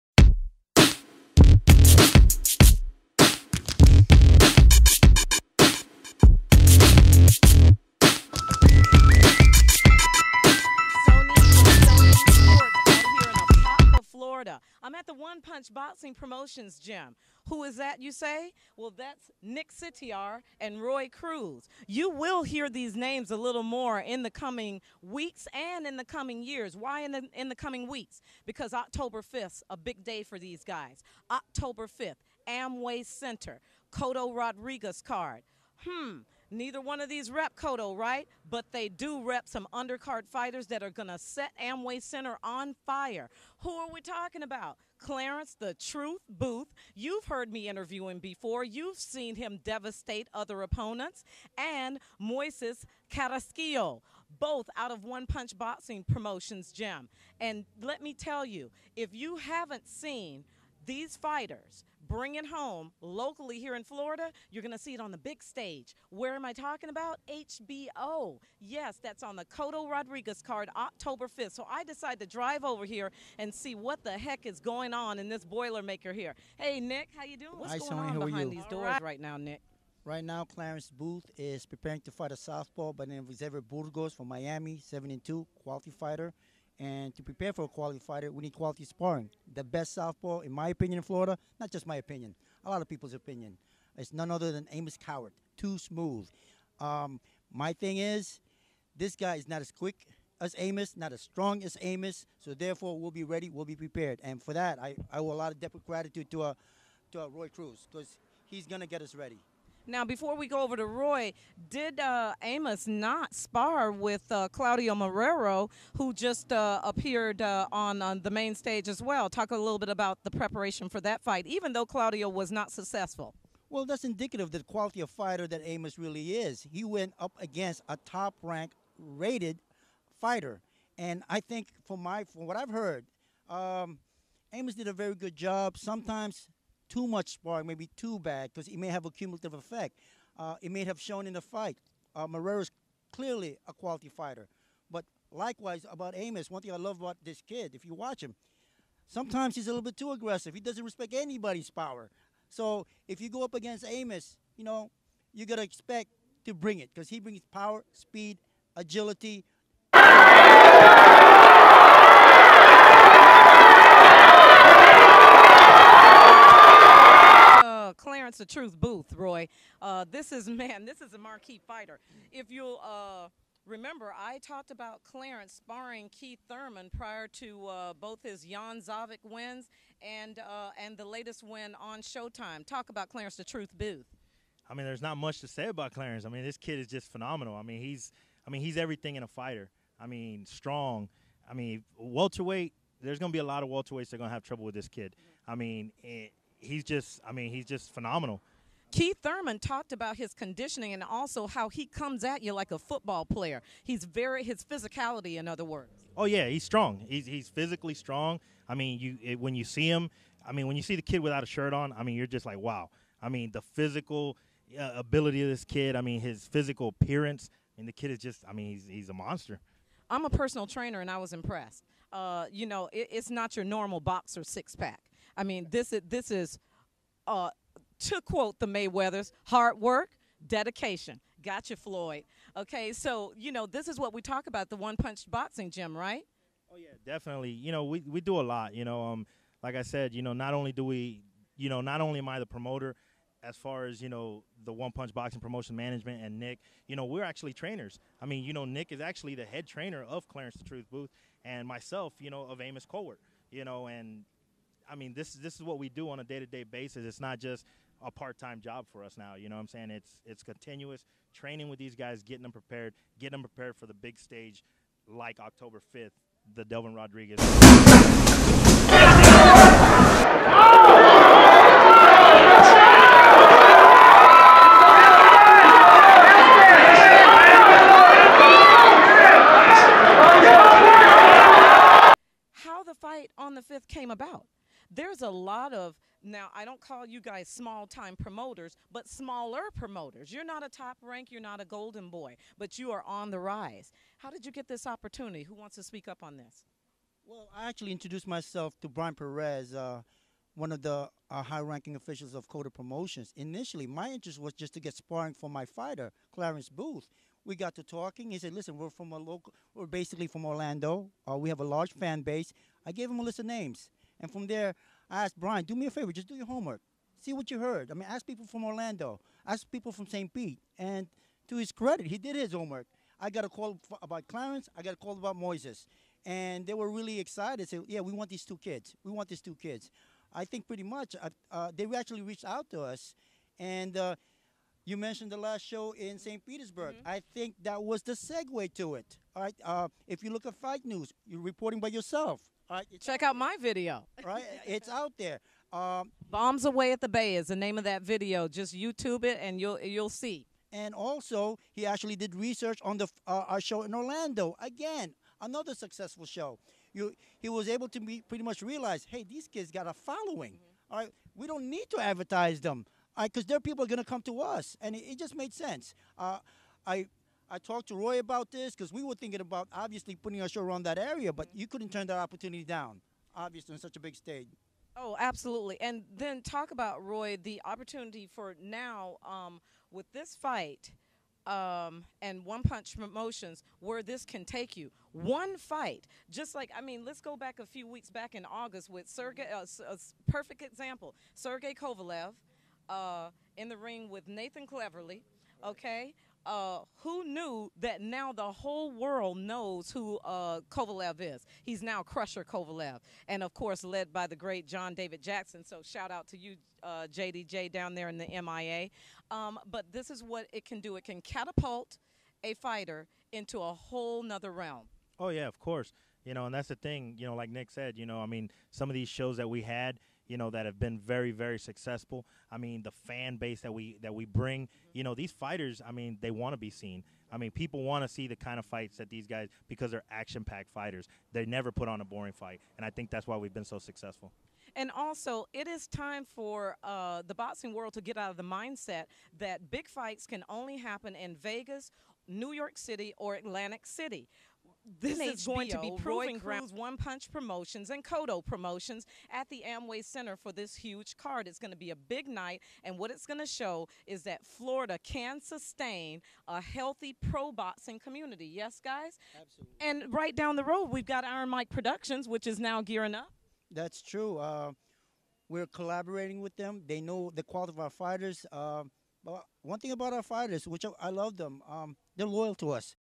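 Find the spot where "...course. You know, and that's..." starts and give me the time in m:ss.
6:55.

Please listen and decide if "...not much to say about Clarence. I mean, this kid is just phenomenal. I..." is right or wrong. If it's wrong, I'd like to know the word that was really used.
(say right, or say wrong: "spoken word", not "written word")
right.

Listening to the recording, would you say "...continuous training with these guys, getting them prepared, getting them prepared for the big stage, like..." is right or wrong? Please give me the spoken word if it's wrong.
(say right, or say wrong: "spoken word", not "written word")
right.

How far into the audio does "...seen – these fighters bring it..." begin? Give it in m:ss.
0:59.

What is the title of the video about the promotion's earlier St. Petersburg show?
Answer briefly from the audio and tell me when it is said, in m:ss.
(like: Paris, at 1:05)
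Bombs away at the bay, at 5:46.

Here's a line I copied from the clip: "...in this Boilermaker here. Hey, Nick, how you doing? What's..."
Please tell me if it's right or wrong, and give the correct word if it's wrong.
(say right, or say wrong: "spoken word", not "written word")
right.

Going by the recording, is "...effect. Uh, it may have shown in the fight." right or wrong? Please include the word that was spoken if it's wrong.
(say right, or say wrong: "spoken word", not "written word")
right.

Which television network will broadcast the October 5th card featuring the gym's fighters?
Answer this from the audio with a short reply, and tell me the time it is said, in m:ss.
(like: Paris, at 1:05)
HBO, at 1:07.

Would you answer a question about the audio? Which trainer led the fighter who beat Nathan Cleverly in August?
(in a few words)
John David Jackson.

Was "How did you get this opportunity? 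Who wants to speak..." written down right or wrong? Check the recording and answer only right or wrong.
right.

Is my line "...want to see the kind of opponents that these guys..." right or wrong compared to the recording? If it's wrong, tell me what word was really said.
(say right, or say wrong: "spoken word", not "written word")
wrong: "fights", not "opponents".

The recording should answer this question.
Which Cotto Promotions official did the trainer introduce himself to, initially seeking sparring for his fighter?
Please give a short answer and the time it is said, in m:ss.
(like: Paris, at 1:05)
Brian Perez, at 4:58.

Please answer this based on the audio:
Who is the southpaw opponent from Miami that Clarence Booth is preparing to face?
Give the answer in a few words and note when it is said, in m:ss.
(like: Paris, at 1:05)
Xavier Burgos, at 1:23.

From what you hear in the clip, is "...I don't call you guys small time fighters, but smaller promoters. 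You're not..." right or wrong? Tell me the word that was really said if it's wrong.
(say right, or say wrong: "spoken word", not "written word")
wrong: "promoters", not "fighters".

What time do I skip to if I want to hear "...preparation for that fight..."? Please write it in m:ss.
2:00.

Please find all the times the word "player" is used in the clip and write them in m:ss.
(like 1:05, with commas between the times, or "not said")
3:23.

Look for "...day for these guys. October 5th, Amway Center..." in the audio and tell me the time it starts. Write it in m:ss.
0:30.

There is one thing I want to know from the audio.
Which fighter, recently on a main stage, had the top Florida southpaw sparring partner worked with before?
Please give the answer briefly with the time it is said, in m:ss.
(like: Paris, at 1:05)
Claudio Marrero, at 1:54.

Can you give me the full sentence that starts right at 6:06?
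Uh, I I talked to Roy about this because we were thinking about obviously putting our show around that area, but mm-hmm.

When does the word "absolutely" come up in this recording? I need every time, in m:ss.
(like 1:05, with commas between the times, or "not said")
6:15, 7:39.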